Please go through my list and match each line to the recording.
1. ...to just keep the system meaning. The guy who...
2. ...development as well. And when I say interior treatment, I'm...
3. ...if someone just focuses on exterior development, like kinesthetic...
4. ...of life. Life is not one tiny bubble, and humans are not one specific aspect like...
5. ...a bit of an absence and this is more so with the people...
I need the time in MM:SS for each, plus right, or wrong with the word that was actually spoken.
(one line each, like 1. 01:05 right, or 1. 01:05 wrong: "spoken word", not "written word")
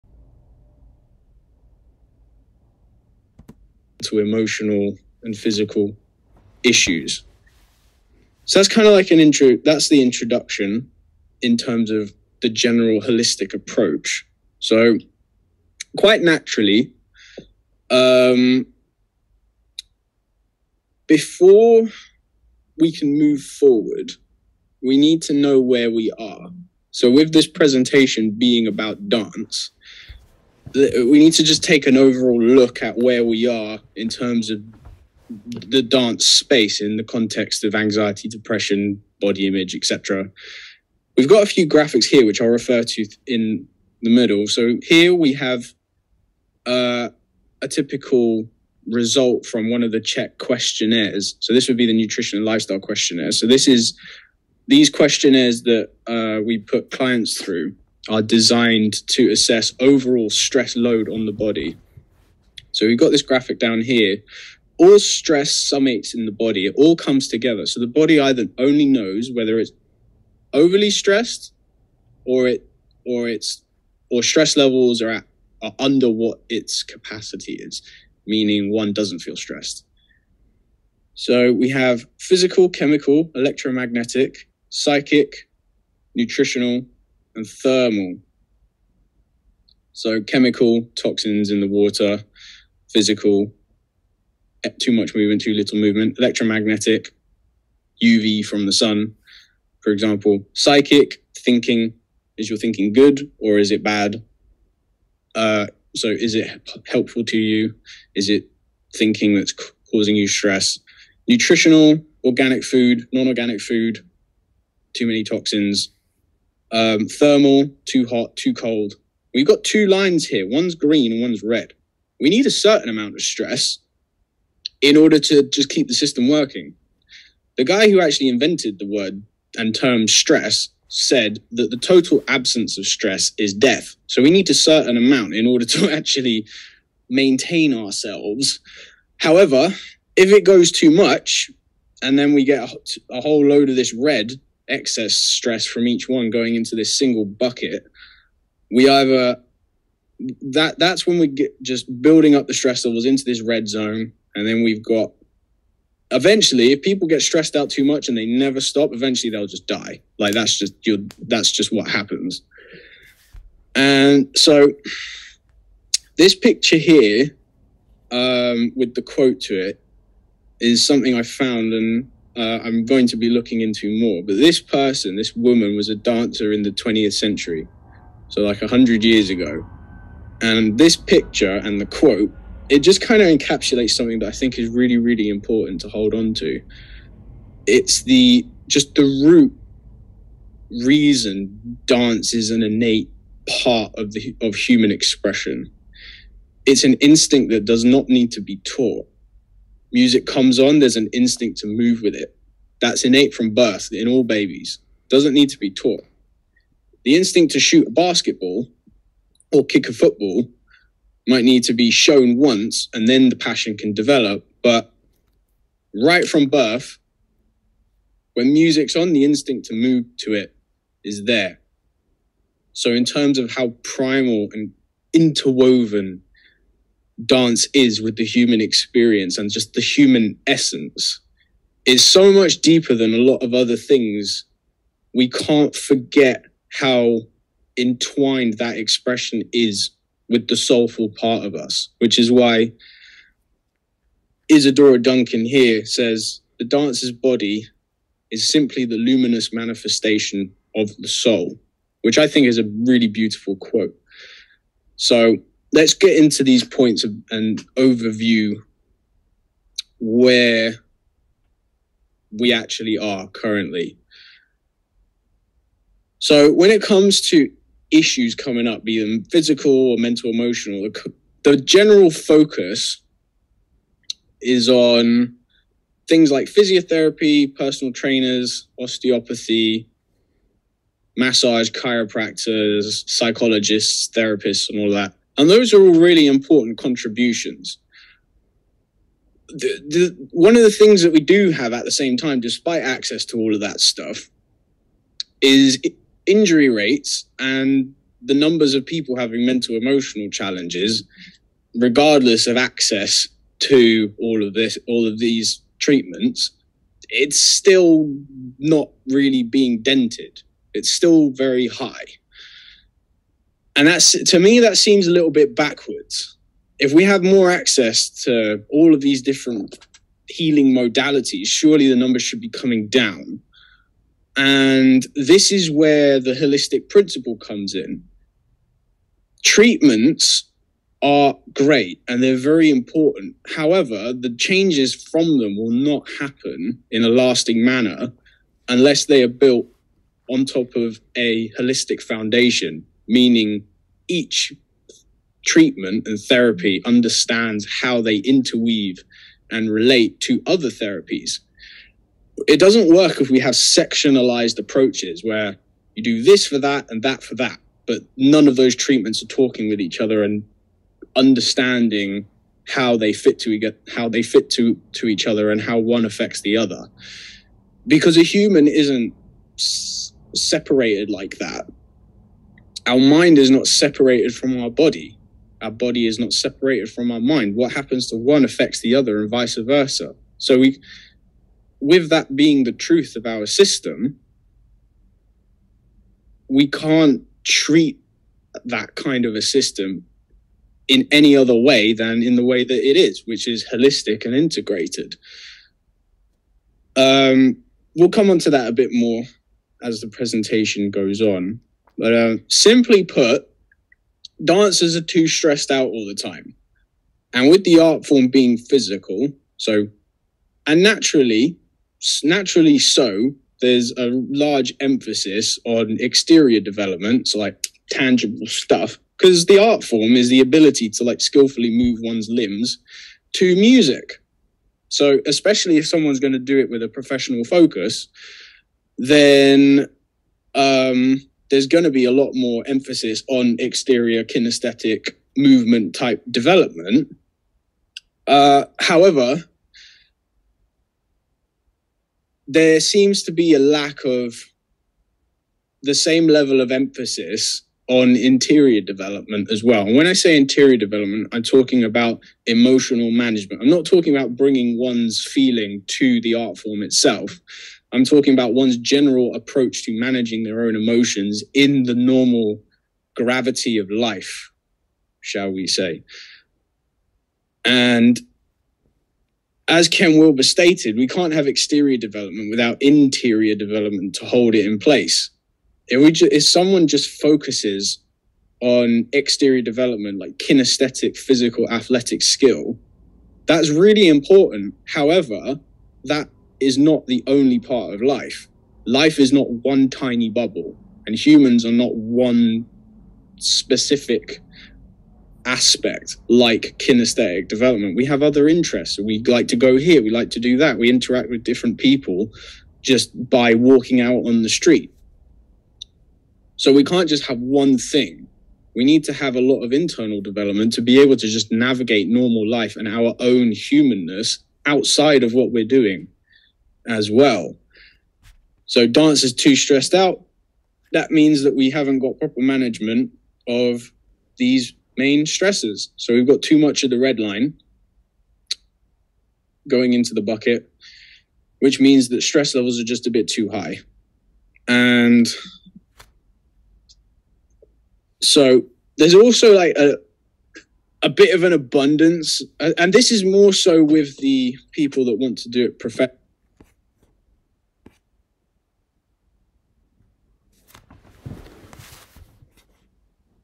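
1. 02:05 wrong: "working", not "meaning"
2. 07:28 wrong: "development", not "treatment"
3. 07:56 right
4. 08:07 right
5. 09:01 wrong: "abundance", not "absence".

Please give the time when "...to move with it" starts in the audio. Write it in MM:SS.
03:21.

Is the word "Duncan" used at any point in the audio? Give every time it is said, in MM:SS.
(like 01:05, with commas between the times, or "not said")
04:04.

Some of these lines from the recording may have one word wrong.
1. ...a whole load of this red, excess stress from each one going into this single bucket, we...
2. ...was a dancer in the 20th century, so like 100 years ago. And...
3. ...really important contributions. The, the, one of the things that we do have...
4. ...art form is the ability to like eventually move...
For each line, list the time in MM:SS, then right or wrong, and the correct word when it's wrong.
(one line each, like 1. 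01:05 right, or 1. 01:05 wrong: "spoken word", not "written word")
1. 02:23 right
2. 02:55 right
3. 04:45 right
4. 06:59 wrong: "skillfully", not "eventually".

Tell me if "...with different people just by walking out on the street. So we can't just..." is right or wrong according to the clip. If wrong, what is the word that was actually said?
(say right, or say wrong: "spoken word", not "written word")
right.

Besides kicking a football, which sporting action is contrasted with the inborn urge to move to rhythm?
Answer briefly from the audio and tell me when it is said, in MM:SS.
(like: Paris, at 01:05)
Shoot a basketball, at 03:27.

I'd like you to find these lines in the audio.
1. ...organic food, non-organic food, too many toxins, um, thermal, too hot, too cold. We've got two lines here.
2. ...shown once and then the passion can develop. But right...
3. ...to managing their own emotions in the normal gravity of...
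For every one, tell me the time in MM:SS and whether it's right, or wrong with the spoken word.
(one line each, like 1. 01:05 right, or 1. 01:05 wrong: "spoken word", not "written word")
1. 01:52 right
2. 03:31 right
3. 07:39 right.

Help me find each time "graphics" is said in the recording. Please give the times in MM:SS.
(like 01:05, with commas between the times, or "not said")
00:41, 01:03.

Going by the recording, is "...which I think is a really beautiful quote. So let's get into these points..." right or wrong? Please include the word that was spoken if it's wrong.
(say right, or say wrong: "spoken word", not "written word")
right.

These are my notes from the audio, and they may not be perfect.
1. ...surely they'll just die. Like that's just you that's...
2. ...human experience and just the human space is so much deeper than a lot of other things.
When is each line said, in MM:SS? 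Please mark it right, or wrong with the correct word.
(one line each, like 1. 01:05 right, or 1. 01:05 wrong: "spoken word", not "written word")
1. 02:38 wrong: "eventually", not "surely"
2. 03:48 wrong: "essence", not "space".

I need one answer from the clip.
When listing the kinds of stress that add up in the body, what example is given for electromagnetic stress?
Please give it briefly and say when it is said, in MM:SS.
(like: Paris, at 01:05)
UV from the sun, at 01:38.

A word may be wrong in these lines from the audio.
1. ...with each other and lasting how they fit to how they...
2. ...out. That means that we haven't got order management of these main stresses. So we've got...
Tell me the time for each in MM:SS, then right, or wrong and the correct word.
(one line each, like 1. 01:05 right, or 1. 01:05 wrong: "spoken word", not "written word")
1. 05:59 wrong: "understanding", not "lasting"
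2. 08:39 wrong: "proper", not "order".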